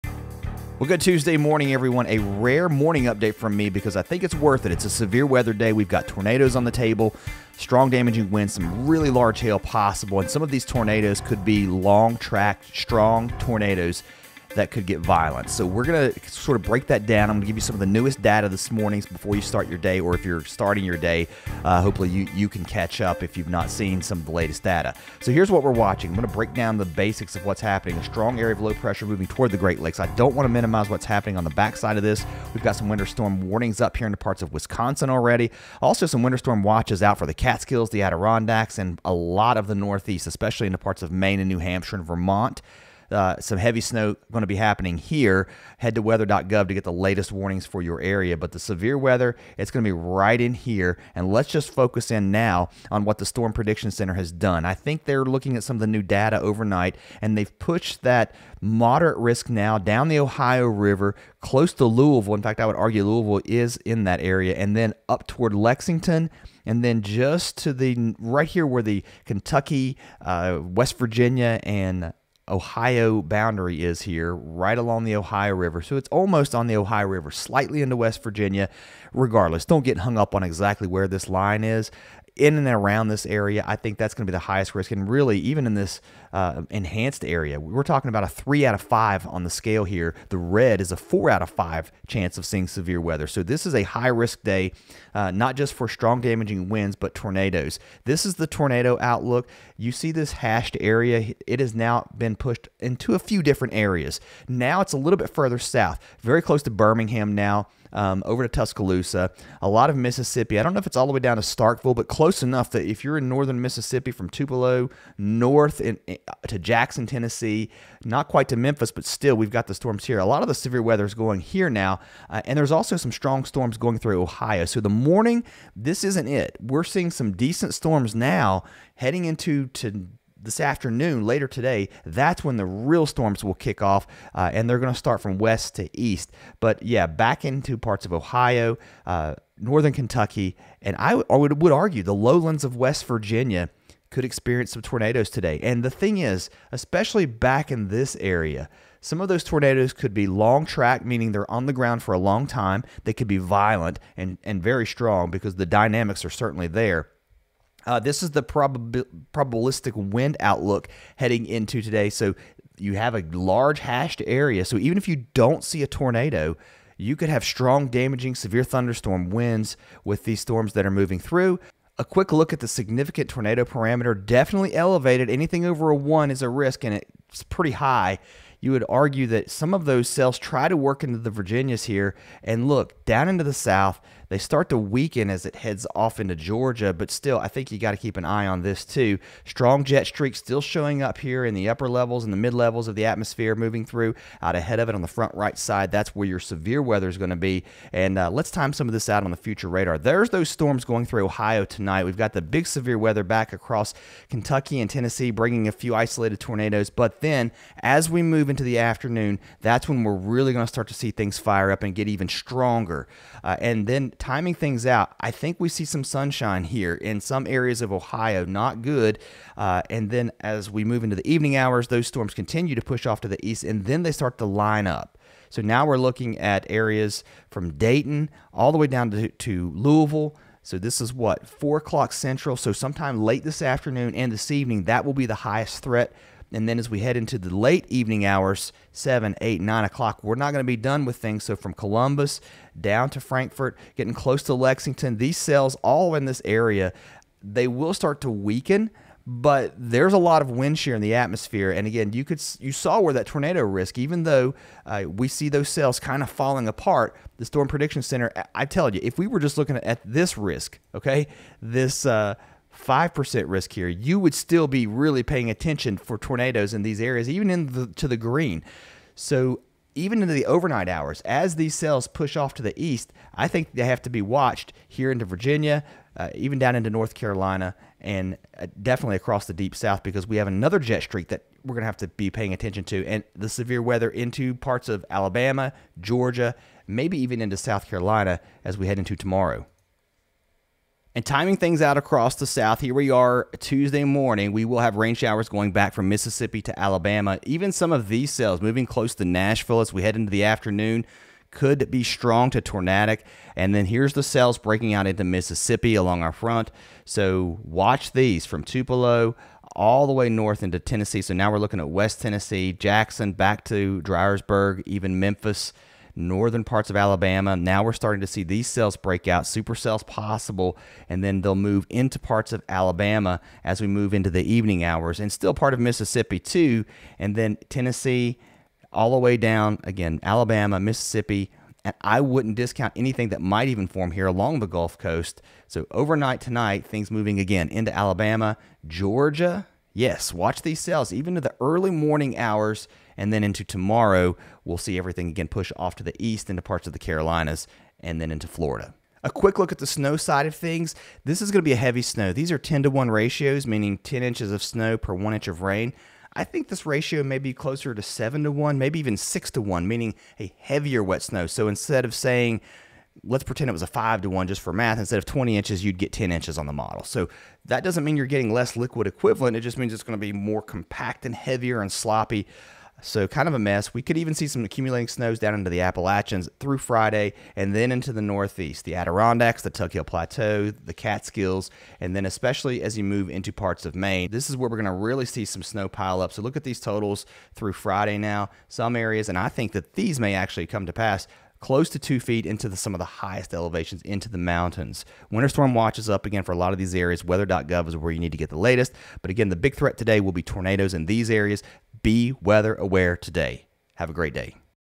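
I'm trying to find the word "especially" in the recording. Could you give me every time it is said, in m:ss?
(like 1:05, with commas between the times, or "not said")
0:40, 2:26, 6:22.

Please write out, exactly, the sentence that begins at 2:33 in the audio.
They could be violent and, and very strong because the dynamics are certainly there.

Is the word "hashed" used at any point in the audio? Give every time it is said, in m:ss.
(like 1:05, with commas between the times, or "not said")
1:40, 2:43.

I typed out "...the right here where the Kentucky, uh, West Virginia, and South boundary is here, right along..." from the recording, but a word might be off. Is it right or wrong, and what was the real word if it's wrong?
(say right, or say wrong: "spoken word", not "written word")
wrong: "Ohio", not "South".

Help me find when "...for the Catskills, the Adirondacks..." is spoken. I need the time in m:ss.
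0:37.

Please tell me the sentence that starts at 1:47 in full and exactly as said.
Um, over to Tuscaloosa, a lot of Mississippi.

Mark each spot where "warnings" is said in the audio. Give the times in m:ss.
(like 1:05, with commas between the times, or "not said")
0:33, 0:47.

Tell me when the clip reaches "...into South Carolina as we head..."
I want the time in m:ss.
4:47.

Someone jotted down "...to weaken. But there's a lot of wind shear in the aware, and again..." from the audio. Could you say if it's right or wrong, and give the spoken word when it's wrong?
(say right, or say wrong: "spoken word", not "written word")
wrong: "atmosphere", not "aware".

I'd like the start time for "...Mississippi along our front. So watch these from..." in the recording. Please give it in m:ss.
5:05.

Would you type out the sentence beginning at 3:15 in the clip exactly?
That's where your severe weather is going to be.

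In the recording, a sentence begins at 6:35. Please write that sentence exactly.
Winter storm watch is up again for a lot of these areas.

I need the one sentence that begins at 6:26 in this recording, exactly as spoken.
So look at these totals through Friday now.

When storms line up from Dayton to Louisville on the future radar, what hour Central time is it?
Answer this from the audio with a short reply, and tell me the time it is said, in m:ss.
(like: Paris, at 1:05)
4 o'clock, at 3:51.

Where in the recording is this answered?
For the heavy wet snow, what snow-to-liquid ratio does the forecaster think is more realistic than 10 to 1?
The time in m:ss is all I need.
5:58.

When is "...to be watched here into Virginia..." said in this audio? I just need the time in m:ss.
4:34.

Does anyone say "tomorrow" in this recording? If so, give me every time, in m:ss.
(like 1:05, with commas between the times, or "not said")
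4:49, 5:43.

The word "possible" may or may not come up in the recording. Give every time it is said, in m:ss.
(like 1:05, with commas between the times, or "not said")
0:09, 5:20.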